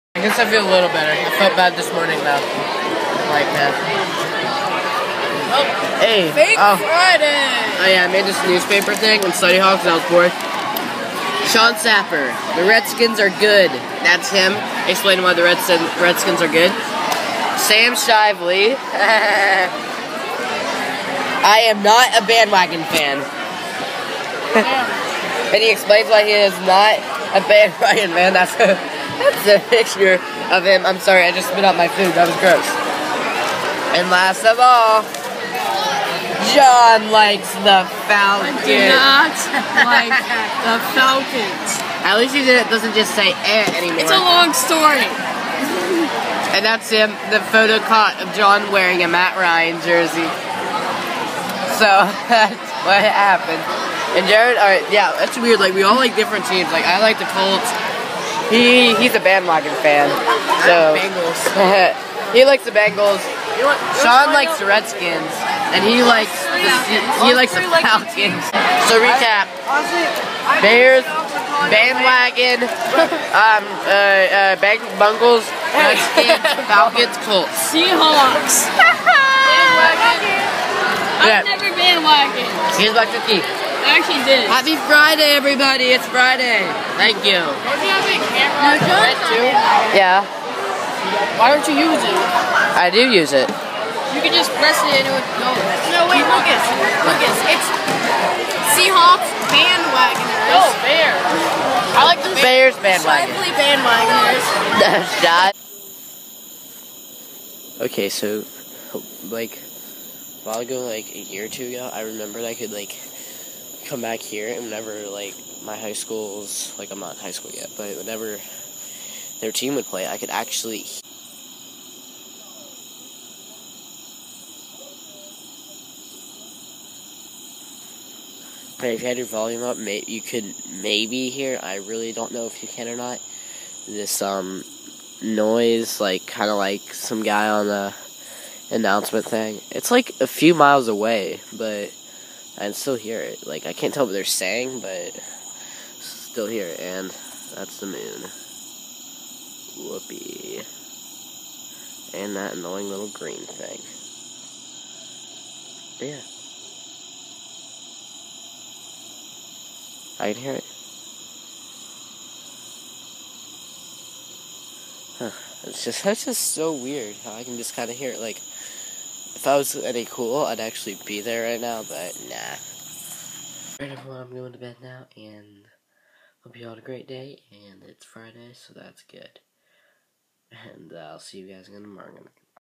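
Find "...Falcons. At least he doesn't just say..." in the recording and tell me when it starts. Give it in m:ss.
0:40.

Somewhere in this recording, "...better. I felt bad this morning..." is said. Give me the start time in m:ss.
0:00.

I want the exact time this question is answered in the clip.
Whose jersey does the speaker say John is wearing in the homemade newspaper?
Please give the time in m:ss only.
0:49.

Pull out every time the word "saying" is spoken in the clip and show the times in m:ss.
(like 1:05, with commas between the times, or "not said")
2:24.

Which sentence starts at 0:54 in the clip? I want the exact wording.
And Jared, alright, yeah, that's weird.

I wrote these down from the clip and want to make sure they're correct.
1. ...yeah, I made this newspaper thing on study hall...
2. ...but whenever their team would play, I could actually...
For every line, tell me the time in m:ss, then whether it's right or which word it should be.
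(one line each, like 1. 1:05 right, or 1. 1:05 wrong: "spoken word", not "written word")
1. 0:07 right
2. 1:57 right.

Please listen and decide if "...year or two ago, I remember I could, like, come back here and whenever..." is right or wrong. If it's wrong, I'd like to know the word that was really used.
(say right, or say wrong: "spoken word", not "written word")
right.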